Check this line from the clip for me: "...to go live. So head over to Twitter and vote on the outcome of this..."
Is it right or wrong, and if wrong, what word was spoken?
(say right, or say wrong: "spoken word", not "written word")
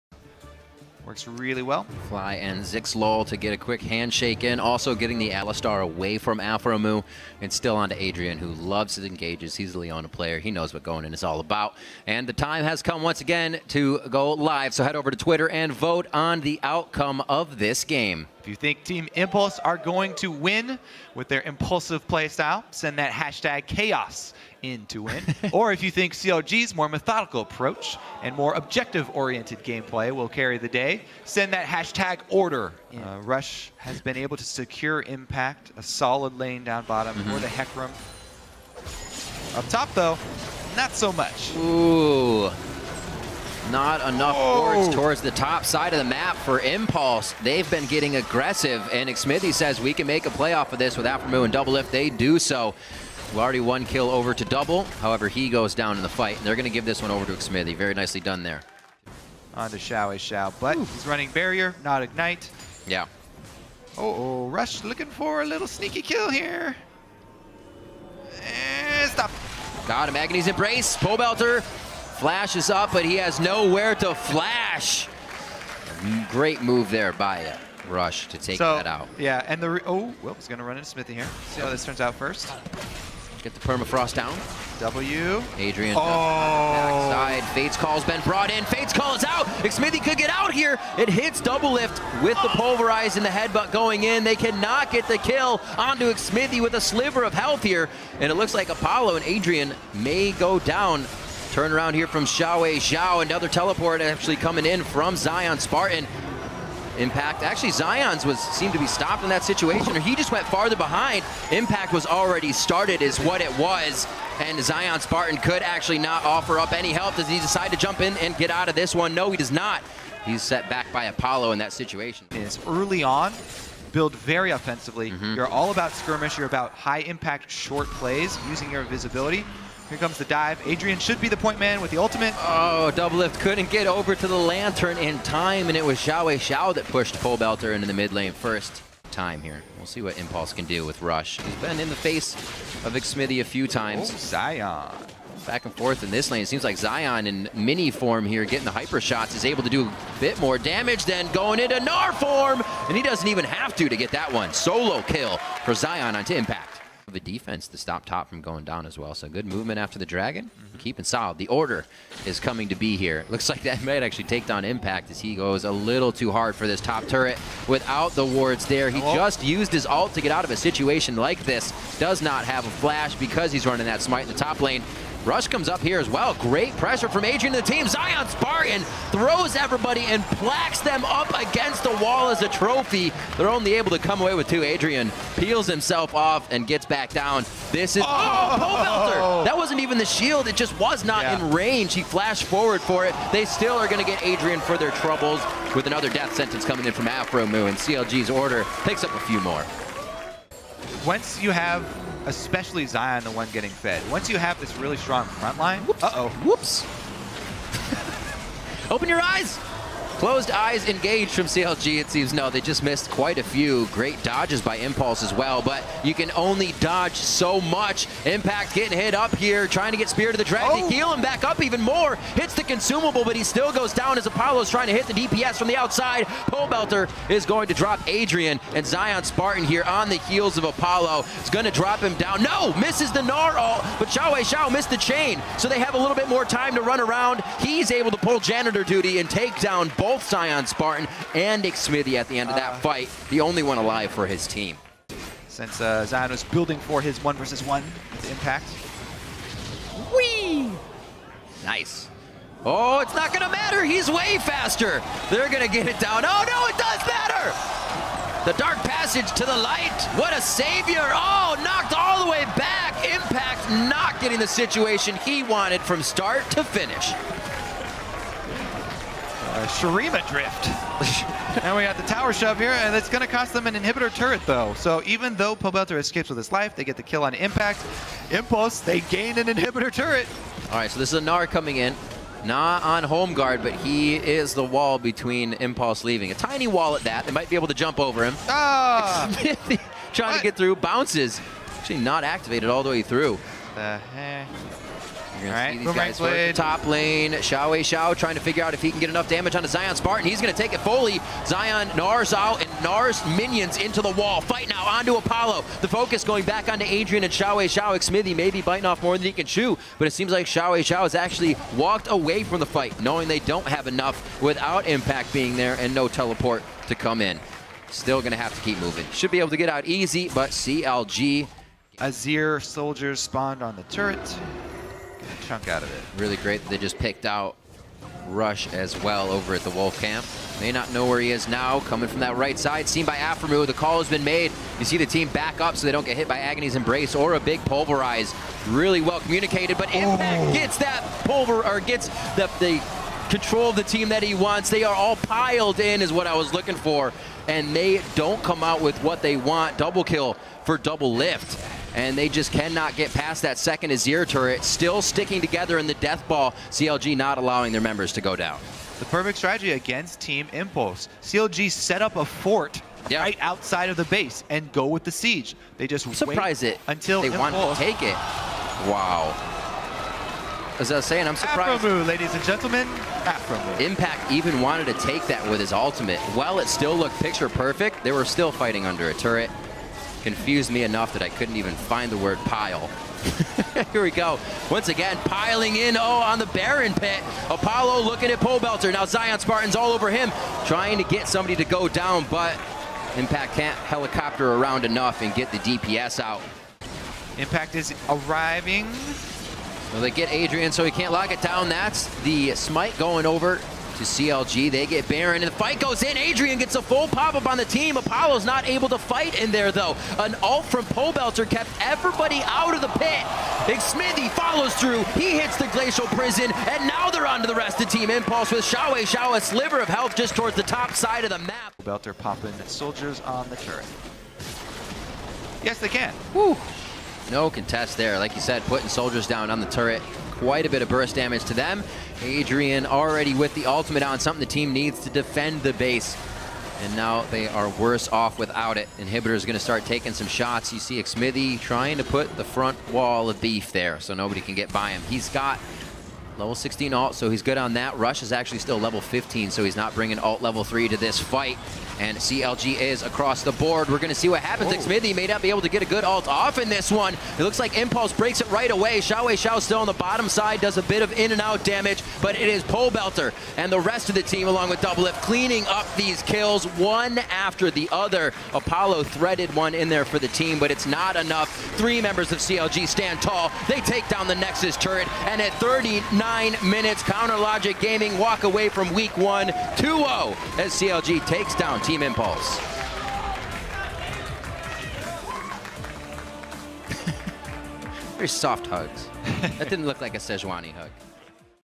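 right.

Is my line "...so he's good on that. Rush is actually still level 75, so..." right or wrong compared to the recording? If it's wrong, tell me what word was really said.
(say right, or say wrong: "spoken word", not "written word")
wrong: "15", not "75".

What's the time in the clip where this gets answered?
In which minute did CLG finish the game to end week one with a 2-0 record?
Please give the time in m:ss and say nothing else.
7:55.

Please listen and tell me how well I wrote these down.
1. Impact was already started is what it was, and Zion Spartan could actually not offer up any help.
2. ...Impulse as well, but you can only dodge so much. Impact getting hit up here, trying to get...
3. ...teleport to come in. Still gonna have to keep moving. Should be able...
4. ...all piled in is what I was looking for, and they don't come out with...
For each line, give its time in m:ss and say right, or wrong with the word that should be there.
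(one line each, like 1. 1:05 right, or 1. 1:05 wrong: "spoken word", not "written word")
1. 1:51 right
2. 3:34 right
3. 5:16 right
4. 5:44 right.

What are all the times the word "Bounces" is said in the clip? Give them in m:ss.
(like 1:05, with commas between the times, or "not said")
4:50.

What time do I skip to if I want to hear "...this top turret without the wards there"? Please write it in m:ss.
2:46.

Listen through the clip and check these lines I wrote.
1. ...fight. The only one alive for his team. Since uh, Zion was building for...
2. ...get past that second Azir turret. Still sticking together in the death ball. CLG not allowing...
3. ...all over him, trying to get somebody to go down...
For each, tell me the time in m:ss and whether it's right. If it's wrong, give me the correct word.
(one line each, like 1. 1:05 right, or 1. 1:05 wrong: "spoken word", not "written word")
1. 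4:02 right
2. 5:52 right
3. 6:29 right.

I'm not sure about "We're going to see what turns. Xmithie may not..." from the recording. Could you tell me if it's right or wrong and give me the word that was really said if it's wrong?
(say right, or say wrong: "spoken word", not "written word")
wrong: "happens", not "turns".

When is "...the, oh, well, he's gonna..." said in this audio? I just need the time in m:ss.
1:19.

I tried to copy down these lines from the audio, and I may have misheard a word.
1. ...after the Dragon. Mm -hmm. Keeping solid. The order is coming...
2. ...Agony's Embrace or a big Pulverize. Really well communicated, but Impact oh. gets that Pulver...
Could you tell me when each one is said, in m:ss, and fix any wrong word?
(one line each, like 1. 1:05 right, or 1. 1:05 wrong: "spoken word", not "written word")
1. 2:39 right
2. 5:36 right.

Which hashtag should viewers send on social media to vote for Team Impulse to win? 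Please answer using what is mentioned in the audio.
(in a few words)
chaos.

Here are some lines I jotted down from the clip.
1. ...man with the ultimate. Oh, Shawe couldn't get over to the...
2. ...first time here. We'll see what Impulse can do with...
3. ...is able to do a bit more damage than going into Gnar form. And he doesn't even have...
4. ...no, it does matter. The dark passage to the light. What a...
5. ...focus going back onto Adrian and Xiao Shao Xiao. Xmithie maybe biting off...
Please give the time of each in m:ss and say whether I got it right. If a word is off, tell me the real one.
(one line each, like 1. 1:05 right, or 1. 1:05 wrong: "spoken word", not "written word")
1. 2:11 wrong: "Doublelift", not "Shawe"
2. 2:18 right
3. 2:29 right
4. 4:16 right
5. 5:05 wrong: "Wei", not "Shao".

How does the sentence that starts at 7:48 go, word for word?
Apollo threaded one in there for the team, but it's not enough.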